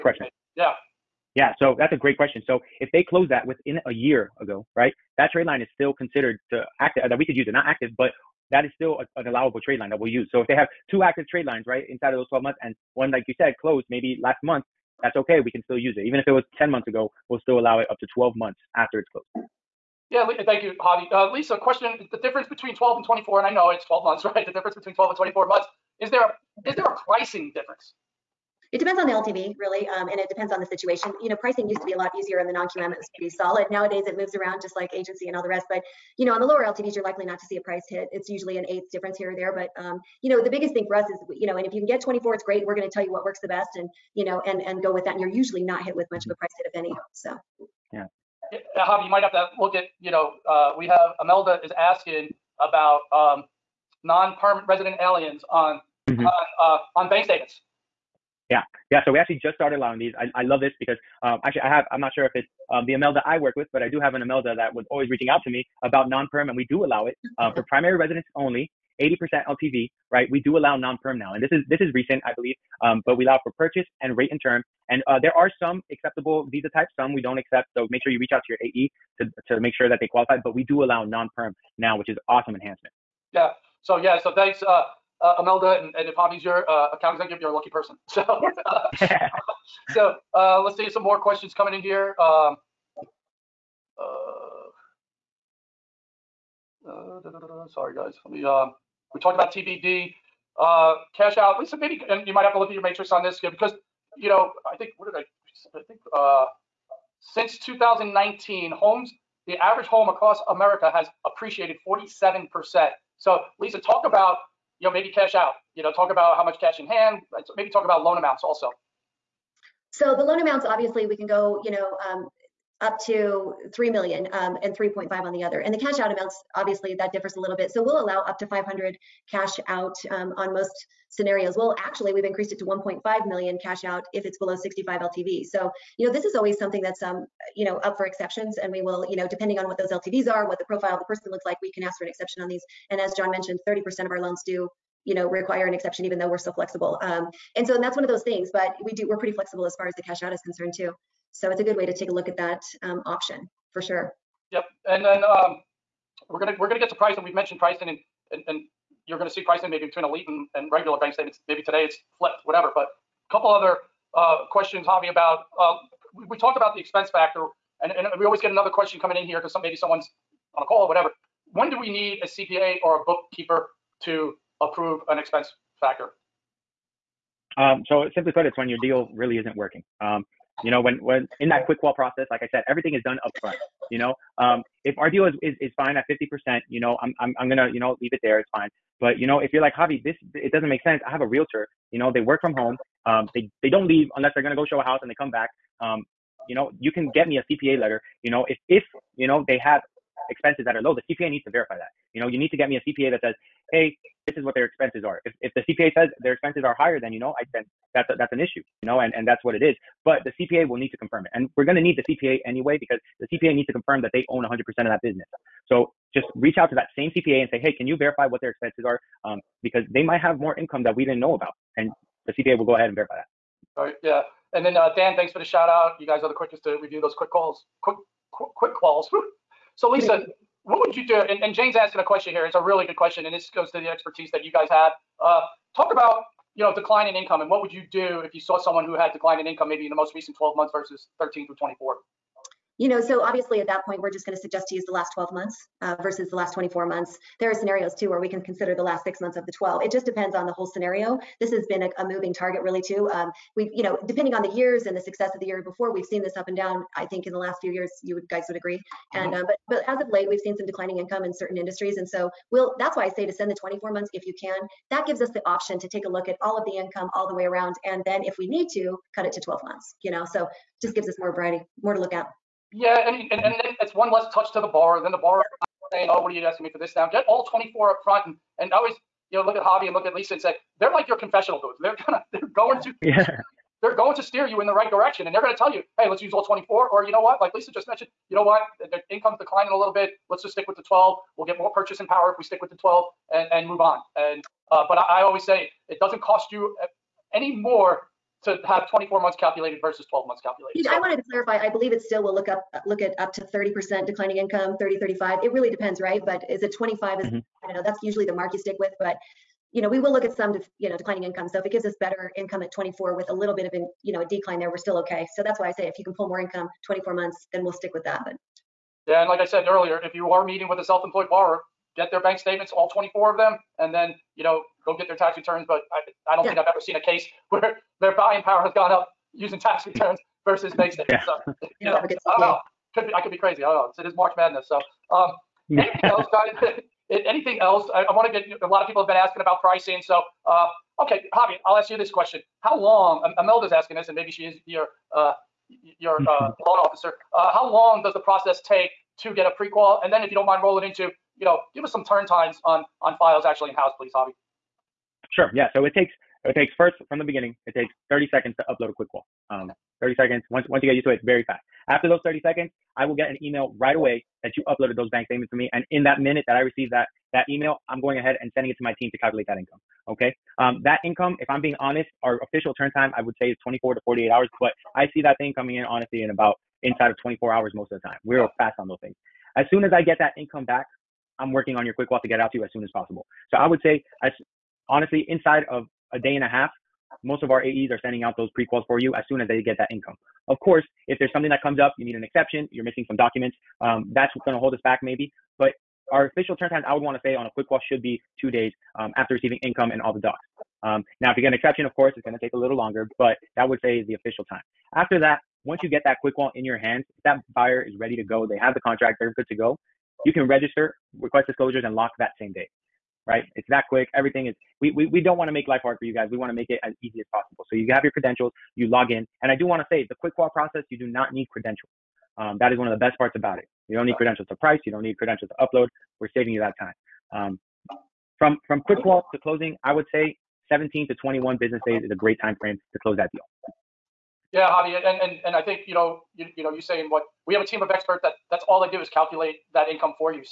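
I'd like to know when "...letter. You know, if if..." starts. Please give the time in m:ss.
3:17.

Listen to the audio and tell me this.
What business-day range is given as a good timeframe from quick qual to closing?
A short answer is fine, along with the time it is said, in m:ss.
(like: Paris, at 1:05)
17 to 21 business days, at 7:10.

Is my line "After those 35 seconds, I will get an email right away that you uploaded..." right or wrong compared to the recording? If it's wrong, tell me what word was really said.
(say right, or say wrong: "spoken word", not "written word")
wrong: "30", not "35".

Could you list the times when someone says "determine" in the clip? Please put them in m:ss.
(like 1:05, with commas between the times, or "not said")
not said.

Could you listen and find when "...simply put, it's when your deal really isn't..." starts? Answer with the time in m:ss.
2:58.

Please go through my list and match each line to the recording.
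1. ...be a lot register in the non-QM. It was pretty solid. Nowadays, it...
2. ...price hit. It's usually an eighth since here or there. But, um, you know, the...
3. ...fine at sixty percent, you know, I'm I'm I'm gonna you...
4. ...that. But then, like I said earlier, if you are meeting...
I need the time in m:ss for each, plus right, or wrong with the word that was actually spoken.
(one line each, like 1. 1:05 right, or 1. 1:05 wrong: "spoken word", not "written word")
1. 0:31 wrong: "easier", not "register"
2. 0:37 wrong: "difference", not "since"
3. 3:05 wrong: "fifty", not "sixty"
4. 5:18 right.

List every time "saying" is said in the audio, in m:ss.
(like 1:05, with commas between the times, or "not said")
4:35, 7:16.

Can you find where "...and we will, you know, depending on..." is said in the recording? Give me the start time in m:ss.
2:18.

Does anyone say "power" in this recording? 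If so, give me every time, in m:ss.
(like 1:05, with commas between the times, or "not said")
4:52, 5:28.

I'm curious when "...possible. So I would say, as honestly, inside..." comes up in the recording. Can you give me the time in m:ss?
6:22.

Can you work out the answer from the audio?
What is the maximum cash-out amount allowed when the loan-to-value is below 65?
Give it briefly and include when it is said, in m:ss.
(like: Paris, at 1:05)
1.5 million, at 2:12.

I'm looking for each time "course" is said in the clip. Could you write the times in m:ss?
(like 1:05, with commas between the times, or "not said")
6:30, 6:41.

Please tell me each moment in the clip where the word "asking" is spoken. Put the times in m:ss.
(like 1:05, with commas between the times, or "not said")
0:51, 3:51, 4:36, 5:39, 5:43.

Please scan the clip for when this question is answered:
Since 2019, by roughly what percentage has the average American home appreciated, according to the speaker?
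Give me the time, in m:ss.
1:51.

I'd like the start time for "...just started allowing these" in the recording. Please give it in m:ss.
0:59.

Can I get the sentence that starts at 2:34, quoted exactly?
Yep, and then um, we're gonna we're gonna get to pricing.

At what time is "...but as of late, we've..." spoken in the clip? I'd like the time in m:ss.
4:19.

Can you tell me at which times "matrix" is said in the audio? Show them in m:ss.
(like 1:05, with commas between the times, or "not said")
1:42.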